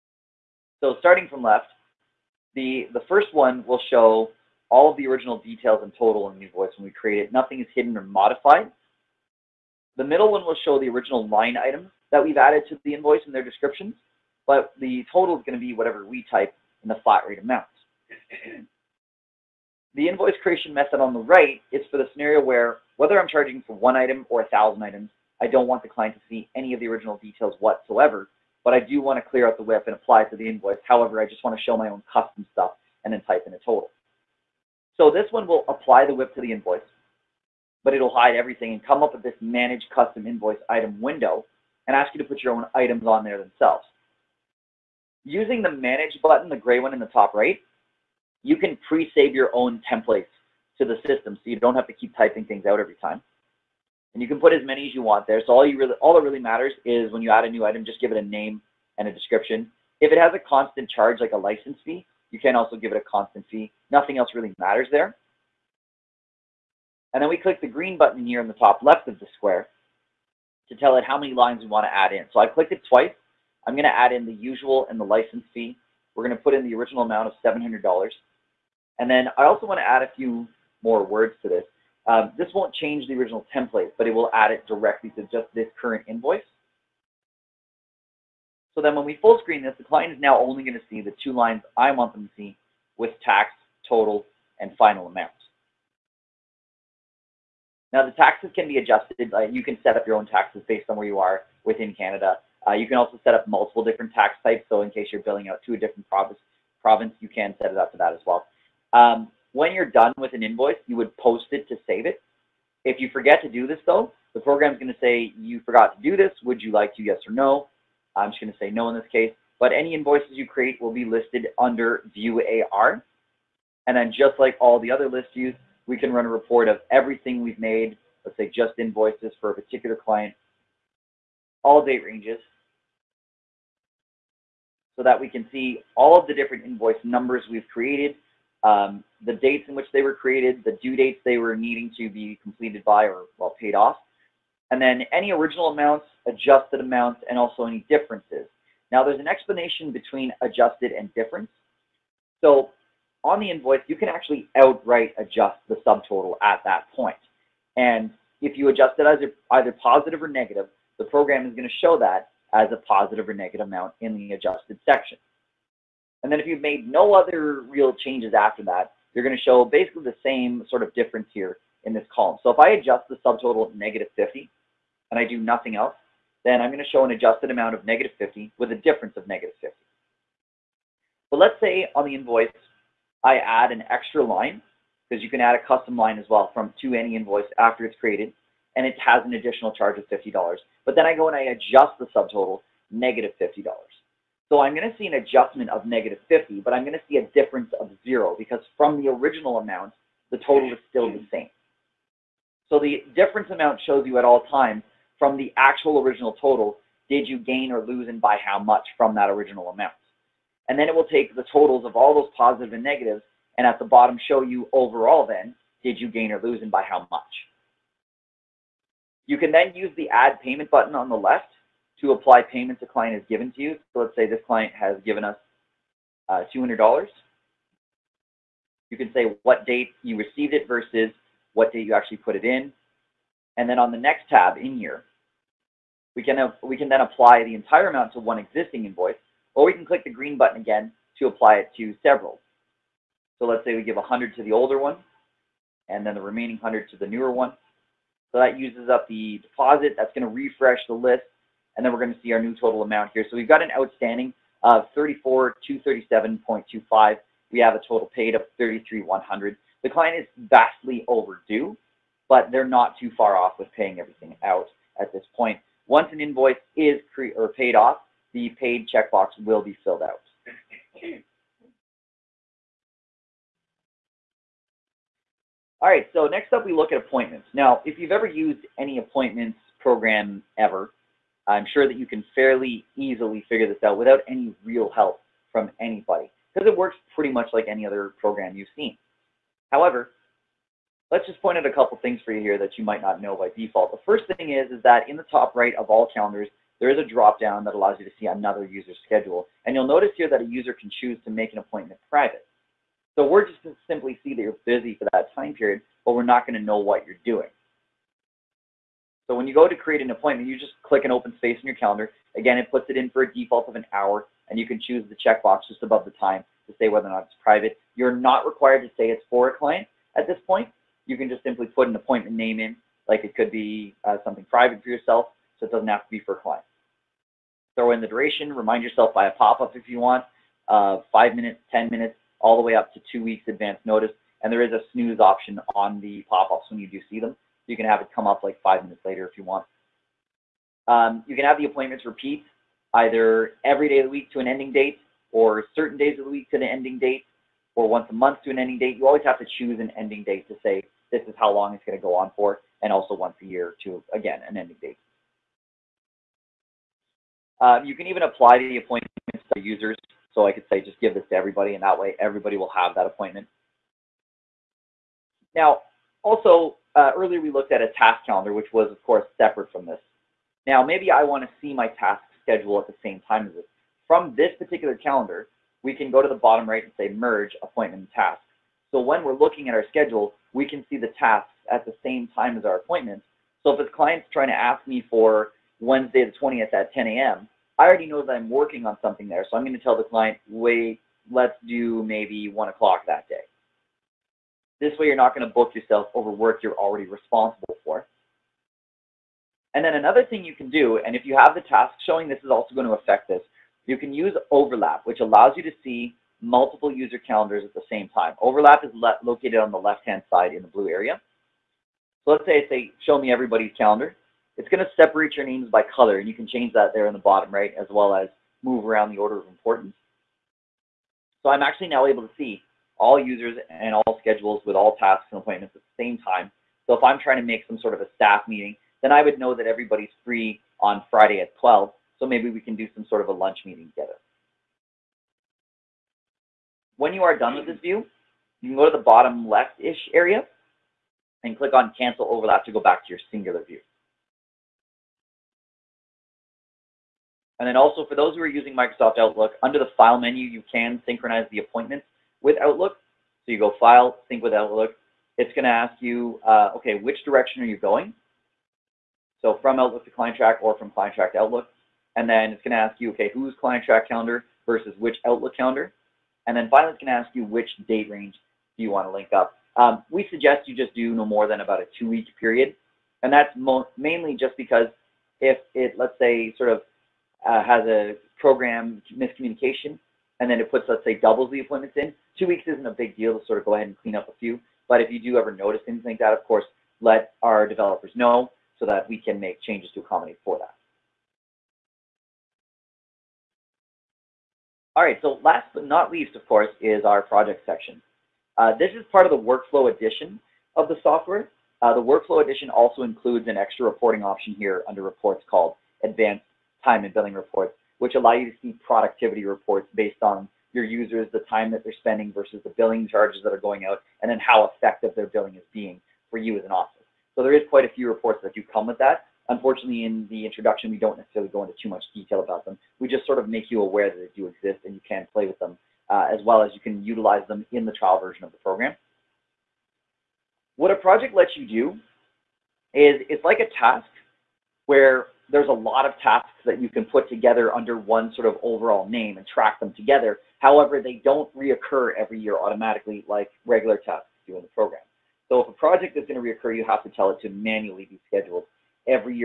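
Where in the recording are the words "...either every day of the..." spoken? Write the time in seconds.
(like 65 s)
342 s.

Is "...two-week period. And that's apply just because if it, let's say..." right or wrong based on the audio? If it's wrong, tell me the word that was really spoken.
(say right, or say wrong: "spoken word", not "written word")
wrong: "mainly", not "apply".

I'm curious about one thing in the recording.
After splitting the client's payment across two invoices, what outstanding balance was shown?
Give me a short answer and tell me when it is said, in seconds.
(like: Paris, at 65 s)
34,237.25, at 254 s.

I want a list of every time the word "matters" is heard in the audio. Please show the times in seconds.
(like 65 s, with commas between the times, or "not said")
56 s, 64 s.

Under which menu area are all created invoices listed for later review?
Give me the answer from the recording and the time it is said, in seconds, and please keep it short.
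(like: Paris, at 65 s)
View AR, at 122 s.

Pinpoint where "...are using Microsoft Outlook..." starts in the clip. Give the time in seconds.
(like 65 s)
448 s.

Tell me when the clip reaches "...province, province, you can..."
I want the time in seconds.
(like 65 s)
106 s.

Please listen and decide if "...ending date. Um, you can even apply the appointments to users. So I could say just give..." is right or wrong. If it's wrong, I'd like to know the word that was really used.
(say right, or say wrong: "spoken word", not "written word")
right.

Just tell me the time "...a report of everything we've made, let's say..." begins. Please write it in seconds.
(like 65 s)
126 s.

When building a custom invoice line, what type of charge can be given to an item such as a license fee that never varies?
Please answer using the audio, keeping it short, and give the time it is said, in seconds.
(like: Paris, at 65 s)
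constant fee, at 63 s.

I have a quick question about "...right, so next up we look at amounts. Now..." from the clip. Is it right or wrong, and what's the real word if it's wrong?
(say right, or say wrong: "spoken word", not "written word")
wrong: "appointments", not "amounts".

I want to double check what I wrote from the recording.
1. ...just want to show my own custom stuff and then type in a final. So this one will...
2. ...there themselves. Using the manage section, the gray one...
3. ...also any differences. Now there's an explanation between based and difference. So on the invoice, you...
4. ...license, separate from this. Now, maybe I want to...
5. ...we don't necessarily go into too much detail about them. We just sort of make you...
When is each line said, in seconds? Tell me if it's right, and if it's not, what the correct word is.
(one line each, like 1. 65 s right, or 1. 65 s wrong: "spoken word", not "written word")
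1. 31 s wrong: "total", not "final"
2. 43 s wrong: "button", not "section"
3. 147 s wrong: "adjusted", not "based"
4. 369 s wrong: "course", not "license"
5. 520 s right.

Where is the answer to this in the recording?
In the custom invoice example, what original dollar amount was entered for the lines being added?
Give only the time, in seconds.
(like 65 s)
77 s.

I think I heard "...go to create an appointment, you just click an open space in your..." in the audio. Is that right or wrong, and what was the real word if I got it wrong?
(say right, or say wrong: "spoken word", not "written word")
right.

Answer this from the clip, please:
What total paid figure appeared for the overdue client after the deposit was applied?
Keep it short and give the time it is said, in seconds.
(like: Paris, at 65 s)
33,100, at 258 s.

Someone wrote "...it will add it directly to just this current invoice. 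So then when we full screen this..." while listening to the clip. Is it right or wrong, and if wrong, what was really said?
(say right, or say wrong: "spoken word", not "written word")
right.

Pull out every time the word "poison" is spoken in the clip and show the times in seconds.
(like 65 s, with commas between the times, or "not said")
not said.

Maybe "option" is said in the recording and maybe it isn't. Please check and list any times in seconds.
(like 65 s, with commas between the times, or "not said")
335 s, 504 s.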